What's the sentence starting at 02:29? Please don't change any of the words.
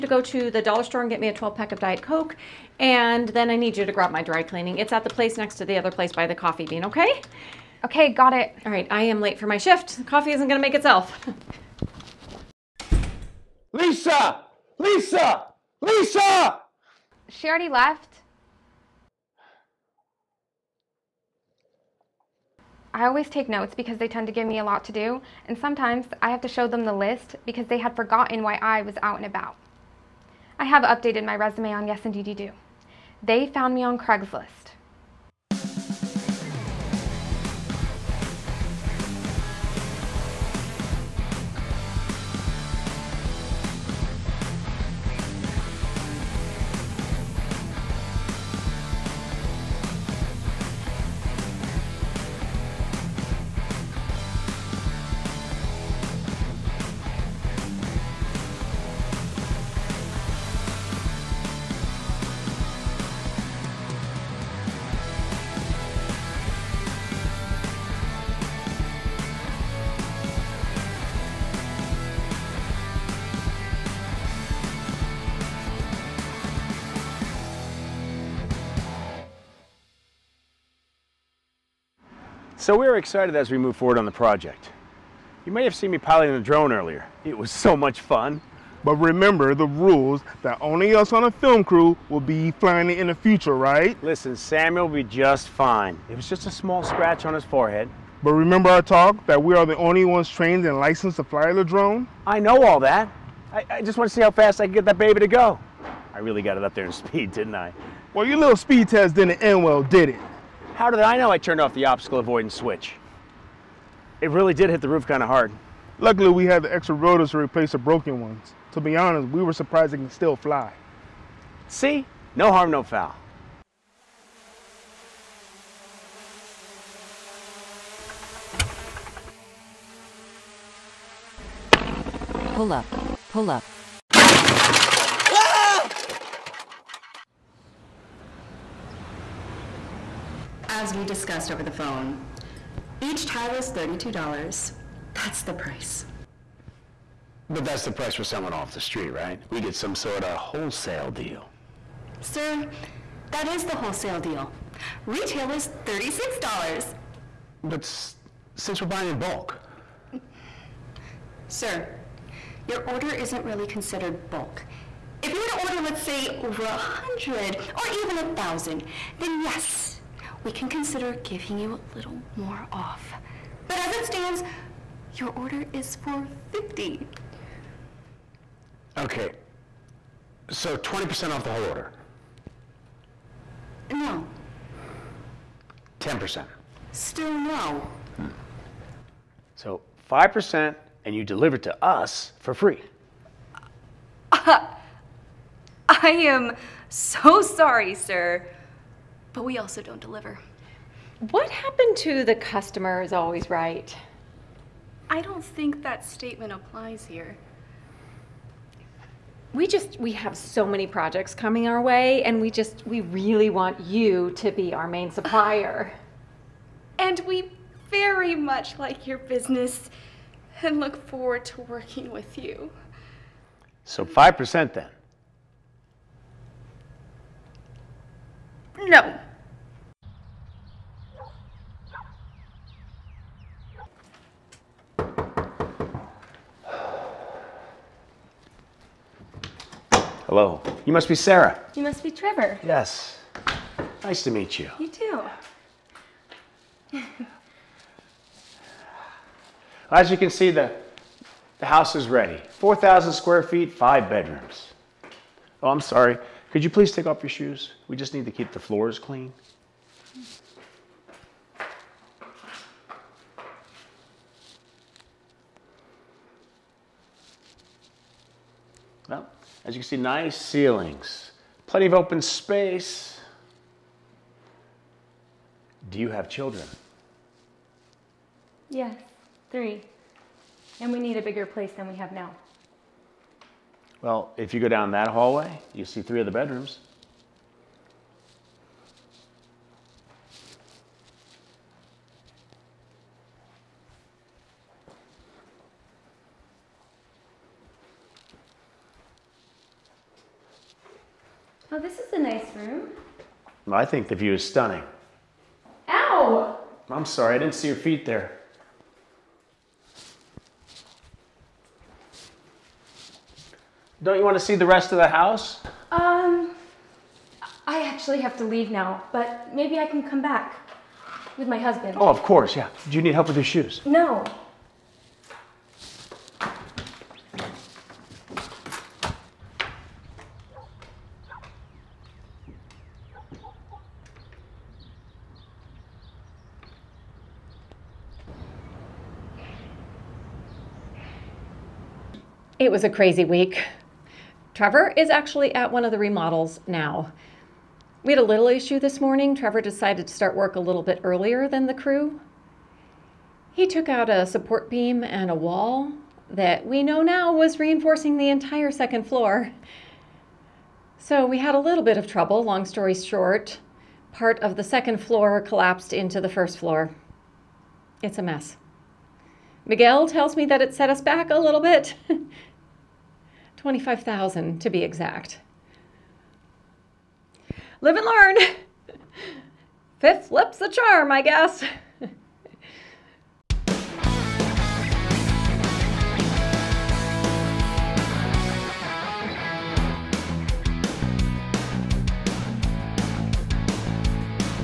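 We get some sort of wholesale deal.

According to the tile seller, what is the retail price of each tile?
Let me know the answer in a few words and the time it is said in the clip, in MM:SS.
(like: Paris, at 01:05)
$36, at 02:35.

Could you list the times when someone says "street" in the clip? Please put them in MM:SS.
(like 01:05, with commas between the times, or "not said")
02:28.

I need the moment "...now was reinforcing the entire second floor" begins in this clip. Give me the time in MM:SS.
05:56.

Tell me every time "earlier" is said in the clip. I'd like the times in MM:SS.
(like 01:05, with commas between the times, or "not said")
01:26, 05:51.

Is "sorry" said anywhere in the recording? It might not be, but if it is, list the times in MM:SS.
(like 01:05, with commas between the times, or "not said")
03:17, 04:15, 05:07.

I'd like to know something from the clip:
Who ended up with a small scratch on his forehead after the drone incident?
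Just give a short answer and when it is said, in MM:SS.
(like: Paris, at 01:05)
Samuel, at 01:34.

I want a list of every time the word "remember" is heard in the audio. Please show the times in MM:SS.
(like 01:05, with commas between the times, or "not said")
01:28, 01:38.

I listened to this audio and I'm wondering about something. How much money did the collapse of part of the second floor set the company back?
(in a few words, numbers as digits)
25,000.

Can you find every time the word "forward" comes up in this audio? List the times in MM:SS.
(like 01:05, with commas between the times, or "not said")
01:23, 03:41.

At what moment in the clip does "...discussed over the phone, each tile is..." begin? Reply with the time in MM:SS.
02:21.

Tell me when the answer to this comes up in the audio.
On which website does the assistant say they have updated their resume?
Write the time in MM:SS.
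00:31.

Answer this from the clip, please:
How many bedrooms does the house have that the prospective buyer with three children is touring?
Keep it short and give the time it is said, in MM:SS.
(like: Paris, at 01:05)
5, at 04:13.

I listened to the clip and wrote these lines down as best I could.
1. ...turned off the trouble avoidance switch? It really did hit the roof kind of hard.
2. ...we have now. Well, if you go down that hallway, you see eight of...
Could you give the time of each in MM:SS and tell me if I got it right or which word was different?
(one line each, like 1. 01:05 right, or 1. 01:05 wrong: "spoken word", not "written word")
1. 01:51 wrong: "obstacle", not "trouble"
2. 04:41 wrong: "three", not "eight".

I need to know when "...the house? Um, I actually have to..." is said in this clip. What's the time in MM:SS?
05:14.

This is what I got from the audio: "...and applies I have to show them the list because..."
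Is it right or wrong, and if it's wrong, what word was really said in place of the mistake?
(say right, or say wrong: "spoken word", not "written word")
wrong: "sometimes", not "applies".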